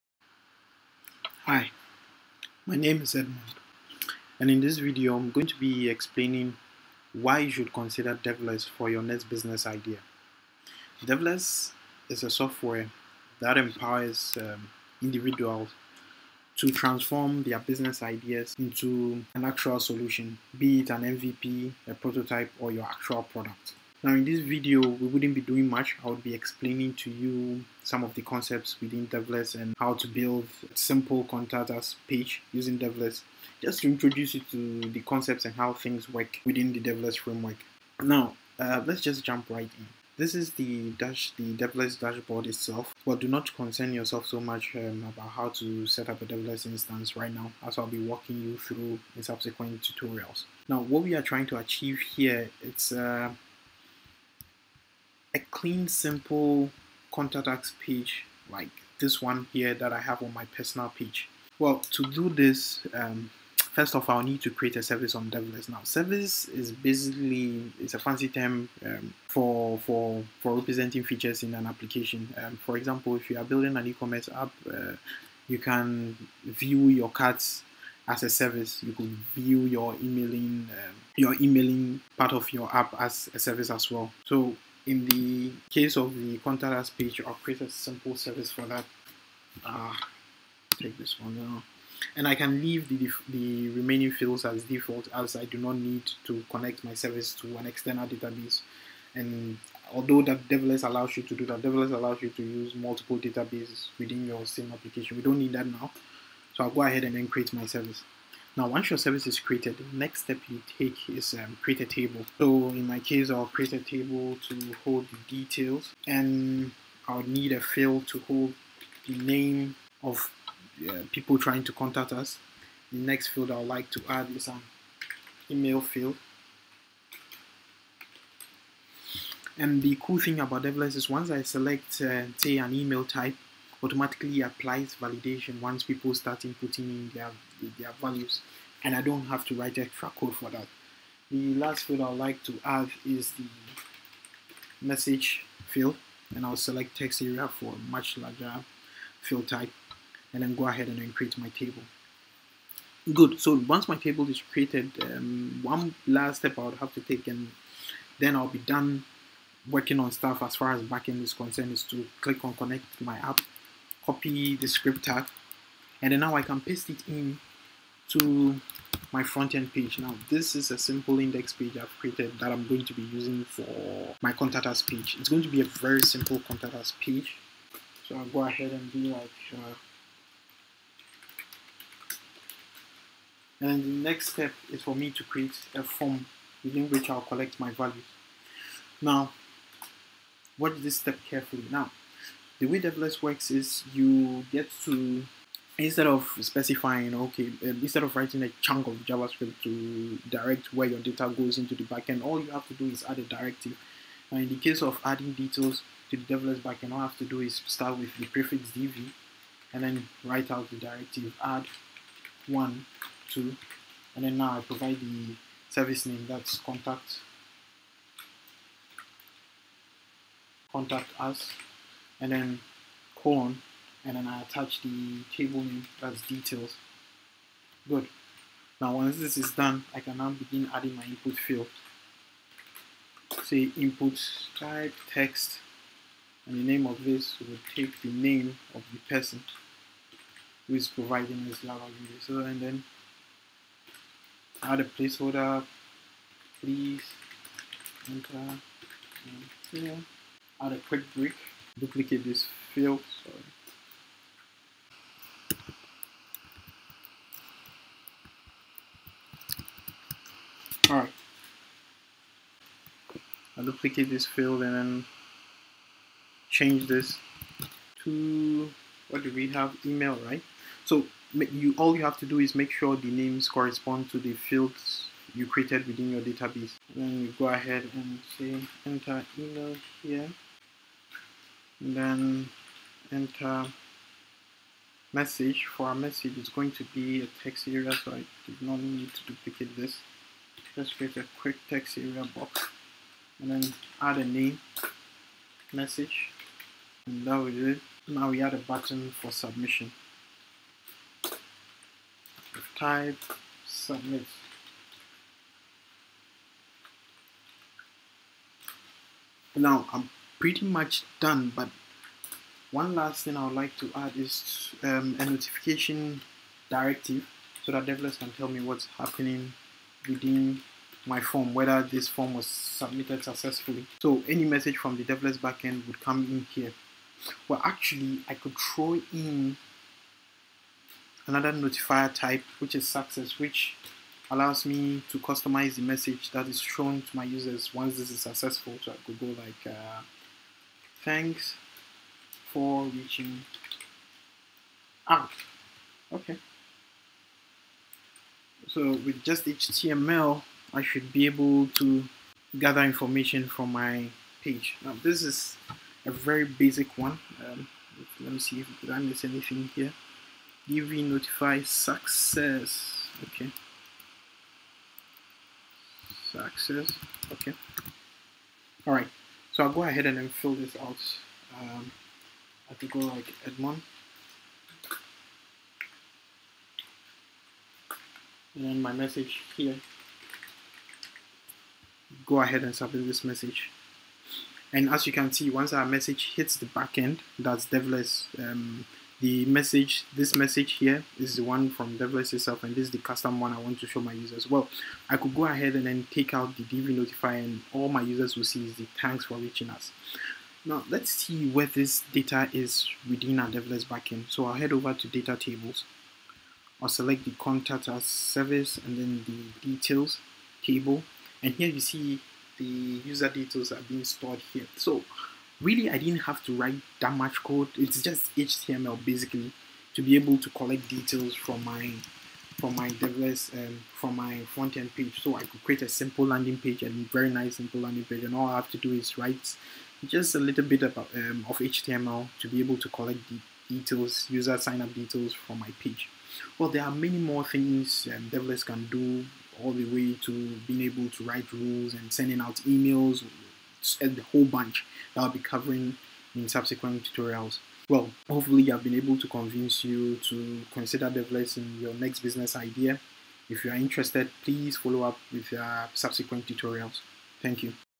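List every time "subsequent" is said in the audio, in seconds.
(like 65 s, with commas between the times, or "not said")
49 s, 446 s, 455 s.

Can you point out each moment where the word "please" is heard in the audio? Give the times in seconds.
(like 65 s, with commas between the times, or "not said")
246 s, 454 s.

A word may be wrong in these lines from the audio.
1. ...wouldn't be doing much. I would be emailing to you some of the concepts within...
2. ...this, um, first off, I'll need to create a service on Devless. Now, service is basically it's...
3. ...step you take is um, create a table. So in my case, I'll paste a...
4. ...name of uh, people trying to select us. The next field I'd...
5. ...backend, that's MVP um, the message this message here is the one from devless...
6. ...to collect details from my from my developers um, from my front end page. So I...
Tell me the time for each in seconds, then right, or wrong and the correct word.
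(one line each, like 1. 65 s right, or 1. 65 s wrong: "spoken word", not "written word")
1. 25 s wrong: "explaining", not "emailing"
2. 62 s right
3. 110 s wrong: "create", not "paste"
4. 119 s wrong: "contact", not "select"
5. 386 s wrong: "Devless", not "MVP"
6. 420 s right.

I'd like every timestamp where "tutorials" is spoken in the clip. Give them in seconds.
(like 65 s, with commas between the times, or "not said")
49 s, 447 s, 456 s.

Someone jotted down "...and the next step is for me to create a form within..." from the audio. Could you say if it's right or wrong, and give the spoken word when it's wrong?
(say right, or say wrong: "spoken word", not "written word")
right.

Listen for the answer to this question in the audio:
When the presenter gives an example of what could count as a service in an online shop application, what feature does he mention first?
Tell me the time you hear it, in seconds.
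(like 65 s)
77 s.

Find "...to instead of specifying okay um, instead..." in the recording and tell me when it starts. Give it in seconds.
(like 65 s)
194 s.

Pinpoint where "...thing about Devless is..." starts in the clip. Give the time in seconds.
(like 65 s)
130 s.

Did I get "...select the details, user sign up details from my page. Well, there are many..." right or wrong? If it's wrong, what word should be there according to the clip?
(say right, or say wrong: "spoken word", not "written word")
wrong: "collect", not "select".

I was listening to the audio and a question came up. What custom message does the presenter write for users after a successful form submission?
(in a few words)
Thanks for reaching out.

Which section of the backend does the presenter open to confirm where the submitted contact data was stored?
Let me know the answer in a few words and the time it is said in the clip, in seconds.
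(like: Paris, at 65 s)
data tables, at 405 s.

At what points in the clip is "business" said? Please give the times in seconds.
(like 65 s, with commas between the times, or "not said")
9 s, 17 s, 452 s.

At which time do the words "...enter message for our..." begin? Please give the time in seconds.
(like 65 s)
283 s.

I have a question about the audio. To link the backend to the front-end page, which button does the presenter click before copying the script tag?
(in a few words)
connect my app.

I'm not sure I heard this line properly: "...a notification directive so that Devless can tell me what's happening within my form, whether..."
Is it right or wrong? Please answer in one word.
right.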